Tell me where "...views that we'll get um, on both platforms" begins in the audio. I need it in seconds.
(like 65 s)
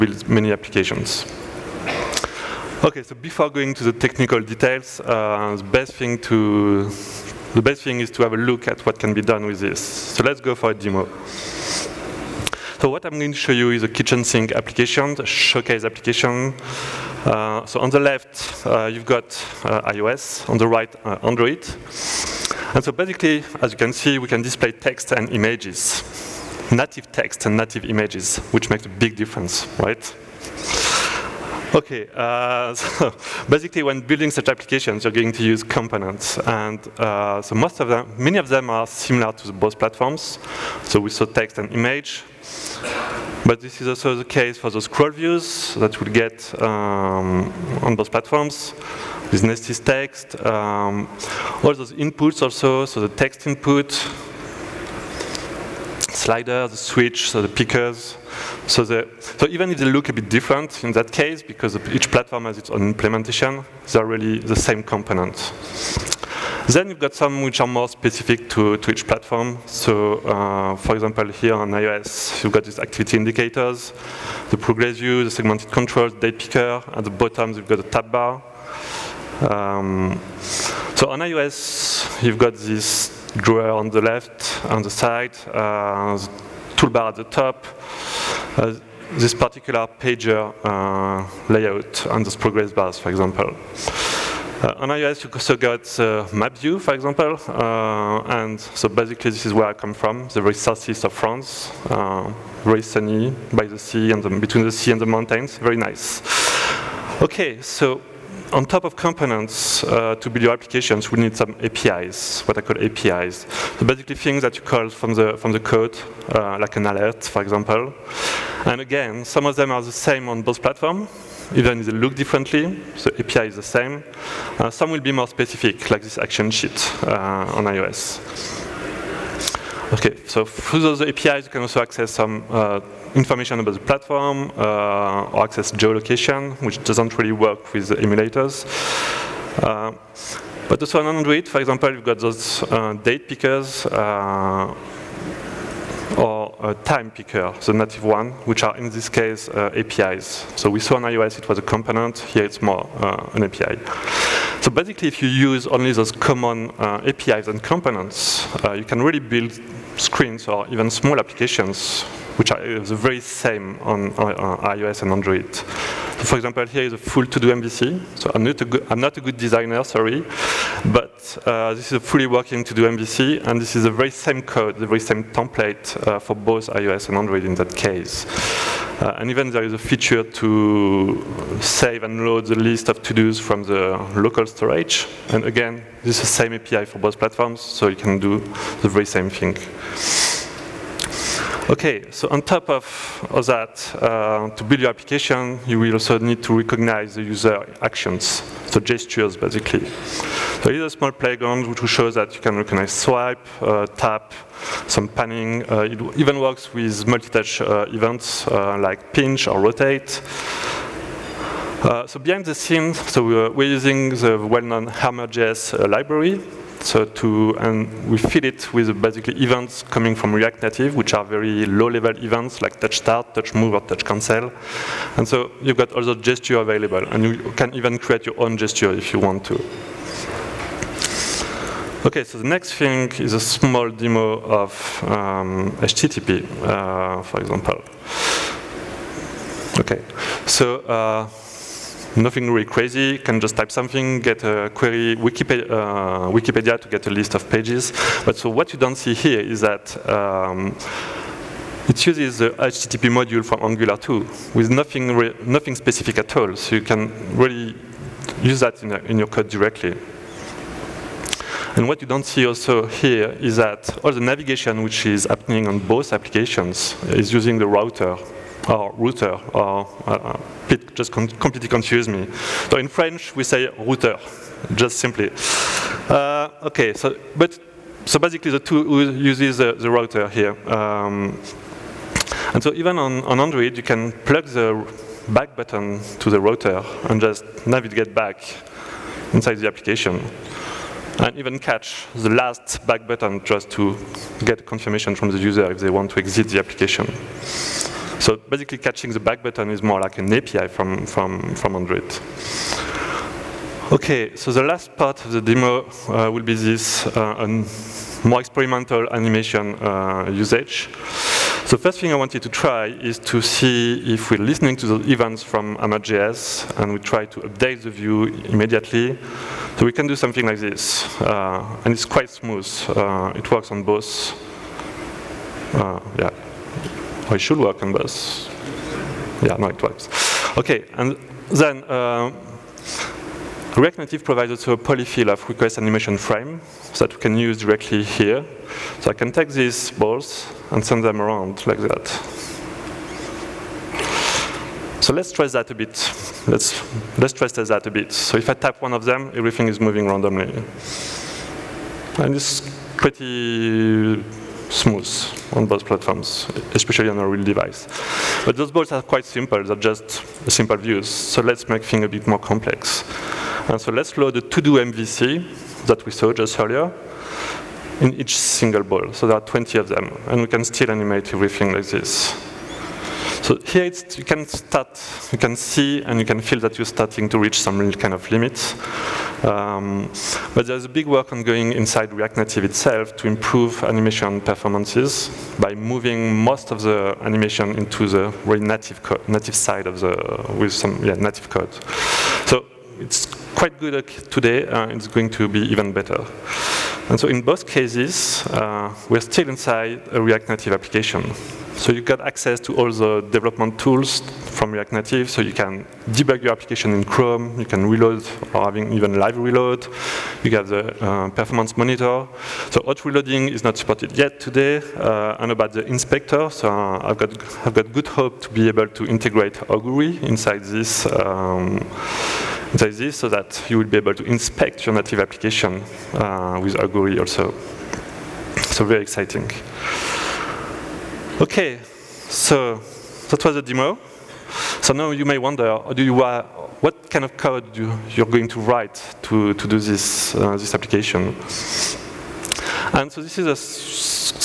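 45 s.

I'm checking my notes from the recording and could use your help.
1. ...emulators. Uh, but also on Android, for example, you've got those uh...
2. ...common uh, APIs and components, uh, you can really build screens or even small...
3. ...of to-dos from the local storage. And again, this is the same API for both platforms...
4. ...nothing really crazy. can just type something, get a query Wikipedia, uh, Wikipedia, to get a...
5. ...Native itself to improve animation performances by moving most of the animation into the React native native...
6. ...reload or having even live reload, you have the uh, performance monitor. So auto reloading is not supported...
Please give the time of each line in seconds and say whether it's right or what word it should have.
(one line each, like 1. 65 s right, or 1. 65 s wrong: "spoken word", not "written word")
1. 137 s right
2. 156 s right
3. 182 s right
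4. 242 s right
5. 382 s right
6. 407 s right.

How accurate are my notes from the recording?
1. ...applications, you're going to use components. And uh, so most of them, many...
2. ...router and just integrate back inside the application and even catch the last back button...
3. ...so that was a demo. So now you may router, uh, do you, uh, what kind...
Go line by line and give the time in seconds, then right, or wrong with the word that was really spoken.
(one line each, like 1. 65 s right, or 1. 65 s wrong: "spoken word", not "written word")
1. 34 s right
2. 286 s wrong: "navigate", not "integrate"
3. 432 s wrong: "wonder", not "router".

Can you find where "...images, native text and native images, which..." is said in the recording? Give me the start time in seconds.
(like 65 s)
25 s.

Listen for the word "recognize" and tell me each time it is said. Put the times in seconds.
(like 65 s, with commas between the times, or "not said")
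196 s, 202 s.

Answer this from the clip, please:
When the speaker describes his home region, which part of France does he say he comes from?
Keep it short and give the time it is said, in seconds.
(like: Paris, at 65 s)
The very southeast, at 100 s.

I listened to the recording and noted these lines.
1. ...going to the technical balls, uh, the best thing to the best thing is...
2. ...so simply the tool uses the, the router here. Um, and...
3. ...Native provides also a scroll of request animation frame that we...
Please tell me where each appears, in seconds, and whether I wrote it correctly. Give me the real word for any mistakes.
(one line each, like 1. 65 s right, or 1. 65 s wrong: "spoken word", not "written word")
1. 3 s wrong: "details", not "balls"
2. 278 s wrong: "basically", not "simply"
3. 333 s wrong: "polyfill", not "scroll".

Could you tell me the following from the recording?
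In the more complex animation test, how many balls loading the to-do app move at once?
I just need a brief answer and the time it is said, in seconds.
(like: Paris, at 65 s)
20, at 369 s.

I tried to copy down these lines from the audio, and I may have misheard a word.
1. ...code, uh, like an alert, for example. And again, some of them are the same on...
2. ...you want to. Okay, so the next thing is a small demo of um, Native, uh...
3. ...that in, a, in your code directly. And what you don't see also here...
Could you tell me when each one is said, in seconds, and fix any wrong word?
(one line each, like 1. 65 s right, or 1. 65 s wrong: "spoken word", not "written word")
1. 115 s right
2. 229 s wrong: "HTTP", not "Native"
3. 258 s right.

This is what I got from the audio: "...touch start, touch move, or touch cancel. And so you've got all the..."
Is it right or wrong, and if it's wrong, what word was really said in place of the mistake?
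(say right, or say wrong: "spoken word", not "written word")
right.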